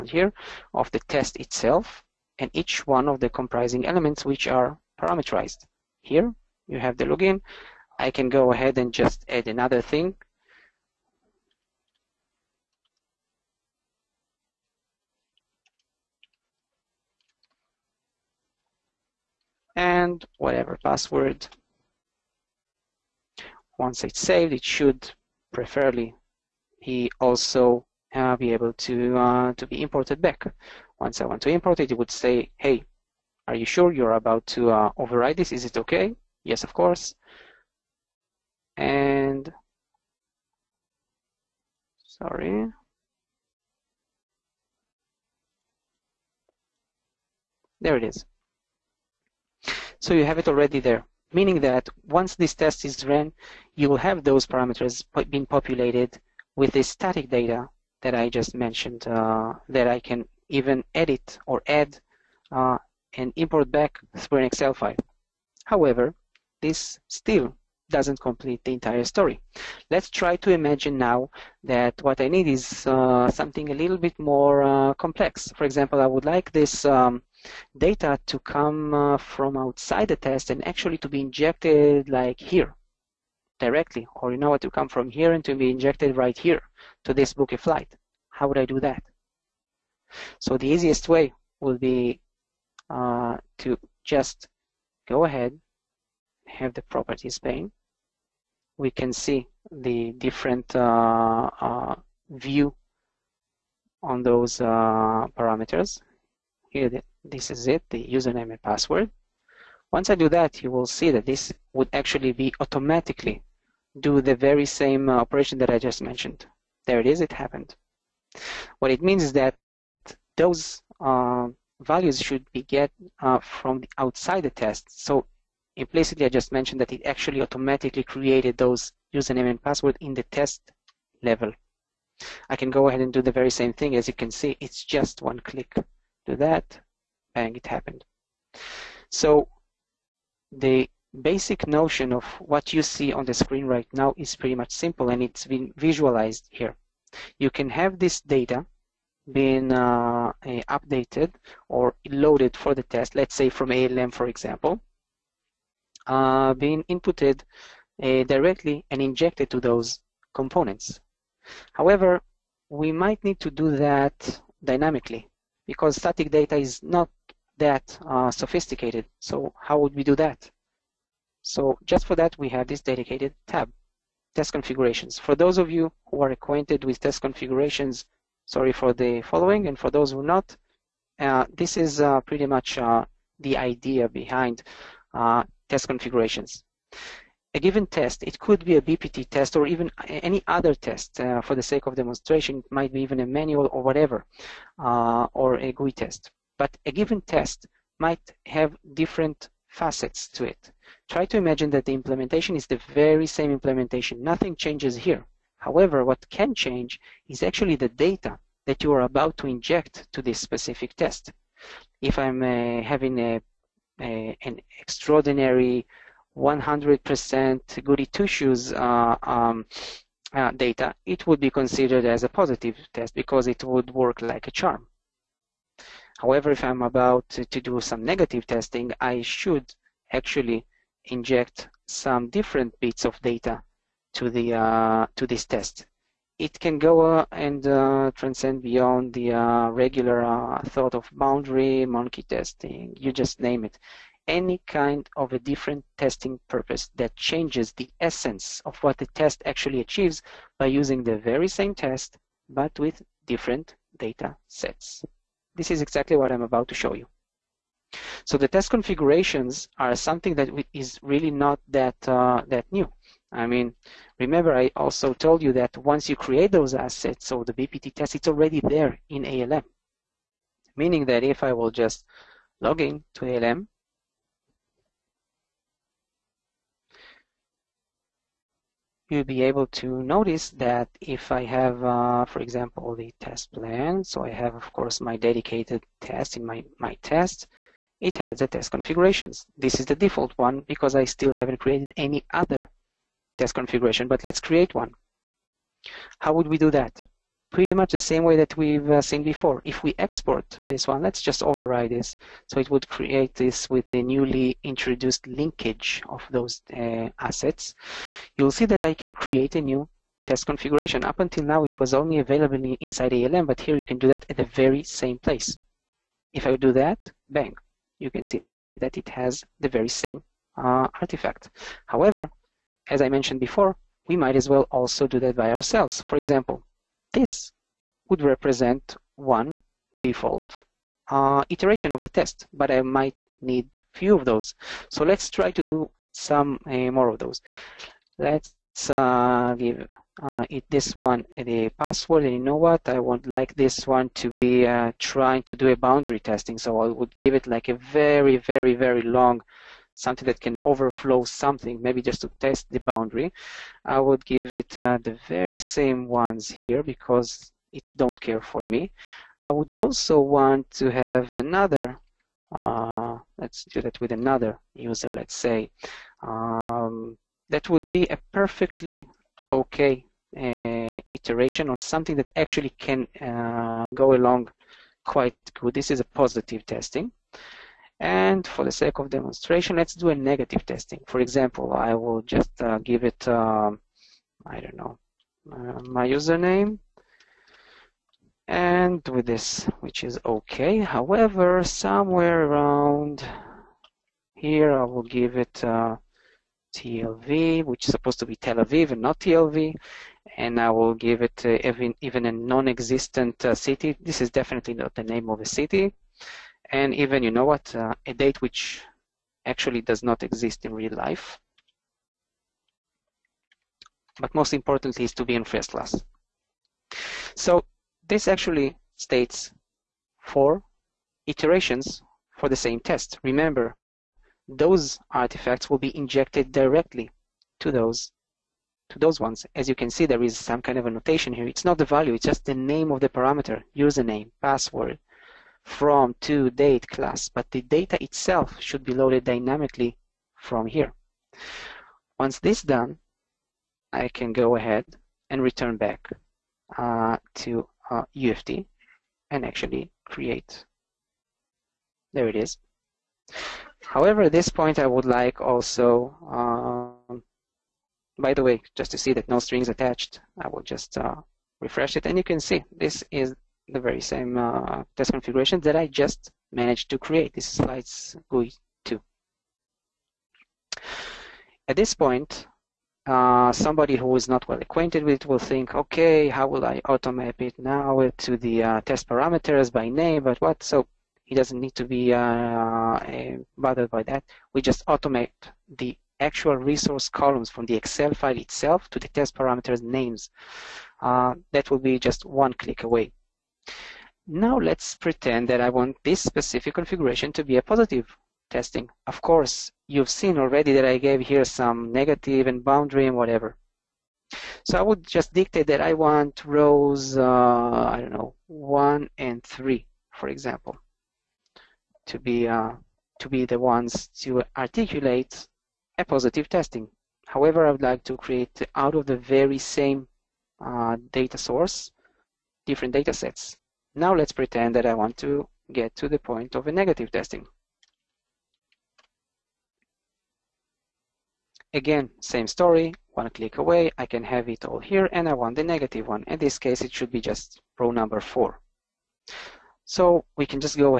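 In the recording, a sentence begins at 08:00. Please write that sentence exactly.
So he doesn't need to be uh, bothered by that.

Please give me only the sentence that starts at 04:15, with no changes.
This is exactly what I'm about to show you.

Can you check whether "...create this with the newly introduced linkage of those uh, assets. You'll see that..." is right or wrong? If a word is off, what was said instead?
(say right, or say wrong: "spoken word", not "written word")
right.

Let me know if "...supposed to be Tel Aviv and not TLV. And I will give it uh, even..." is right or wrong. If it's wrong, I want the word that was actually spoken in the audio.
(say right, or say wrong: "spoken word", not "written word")
right.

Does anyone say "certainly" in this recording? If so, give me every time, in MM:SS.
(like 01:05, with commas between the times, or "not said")
not said.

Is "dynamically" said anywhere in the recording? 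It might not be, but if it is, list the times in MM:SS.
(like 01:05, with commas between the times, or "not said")
02:44, 07:19.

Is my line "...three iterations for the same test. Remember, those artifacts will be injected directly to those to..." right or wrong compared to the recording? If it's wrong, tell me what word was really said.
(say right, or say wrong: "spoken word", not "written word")
wrong: "four", not "three".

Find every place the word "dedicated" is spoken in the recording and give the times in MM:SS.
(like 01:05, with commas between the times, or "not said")
02:52, 04:45.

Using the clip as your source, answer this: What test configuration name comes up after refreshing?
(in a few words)
slides GUI 2.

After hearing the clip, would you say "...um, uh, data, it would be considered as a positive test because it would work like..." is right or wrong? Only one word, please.
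right.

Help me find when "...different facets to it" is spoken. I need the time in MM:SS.
03:18.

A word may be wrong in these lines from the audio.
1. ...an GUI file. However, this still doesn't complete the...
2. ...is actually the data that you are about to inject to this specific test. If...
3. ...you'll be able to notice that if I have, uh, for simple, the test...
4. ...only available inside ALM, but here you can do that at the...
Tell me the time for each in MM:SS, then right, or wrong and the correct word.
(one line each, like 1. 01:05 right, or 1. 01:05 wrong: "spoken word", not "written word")
1. 01:04 wrong: "Excel", not "GUI"
2. 03:27 right
3. 04:39 wrong: "example", not "simple"
4. 05:11 right.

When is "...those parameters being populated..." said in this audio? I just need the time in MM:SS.
00:54.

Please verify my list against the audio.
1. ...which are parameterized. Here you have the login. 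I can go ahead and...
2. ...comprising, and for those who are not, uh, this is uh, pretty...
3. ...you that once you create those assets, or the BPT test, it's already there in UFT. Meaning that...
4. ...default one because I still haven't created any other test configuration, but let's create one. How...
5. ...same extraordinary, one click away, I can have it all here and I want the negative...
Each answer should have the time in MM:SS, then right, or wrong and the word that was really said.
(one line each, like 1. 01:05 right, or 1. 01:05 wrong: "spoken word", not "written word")
1. 00:04 right
2. 02:59 wrong: "following", not "comprising"
3. 04:25 wrong: "ALM", not "UFT"
4. 04:49 right
5. 08:52 wrong: "story", not "extraordinary".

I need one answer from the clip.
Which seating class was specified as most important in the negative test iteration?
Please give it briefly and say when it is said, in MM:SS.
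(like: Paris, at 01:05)
first class, at 06:55.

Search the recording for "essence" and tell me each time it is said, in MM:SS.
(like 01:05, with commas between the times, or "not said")
04:07.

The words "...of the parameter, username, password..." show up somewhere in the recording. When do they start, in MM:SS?
07:12.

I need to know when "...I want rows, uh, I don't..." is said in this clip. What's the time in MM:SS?
08:25.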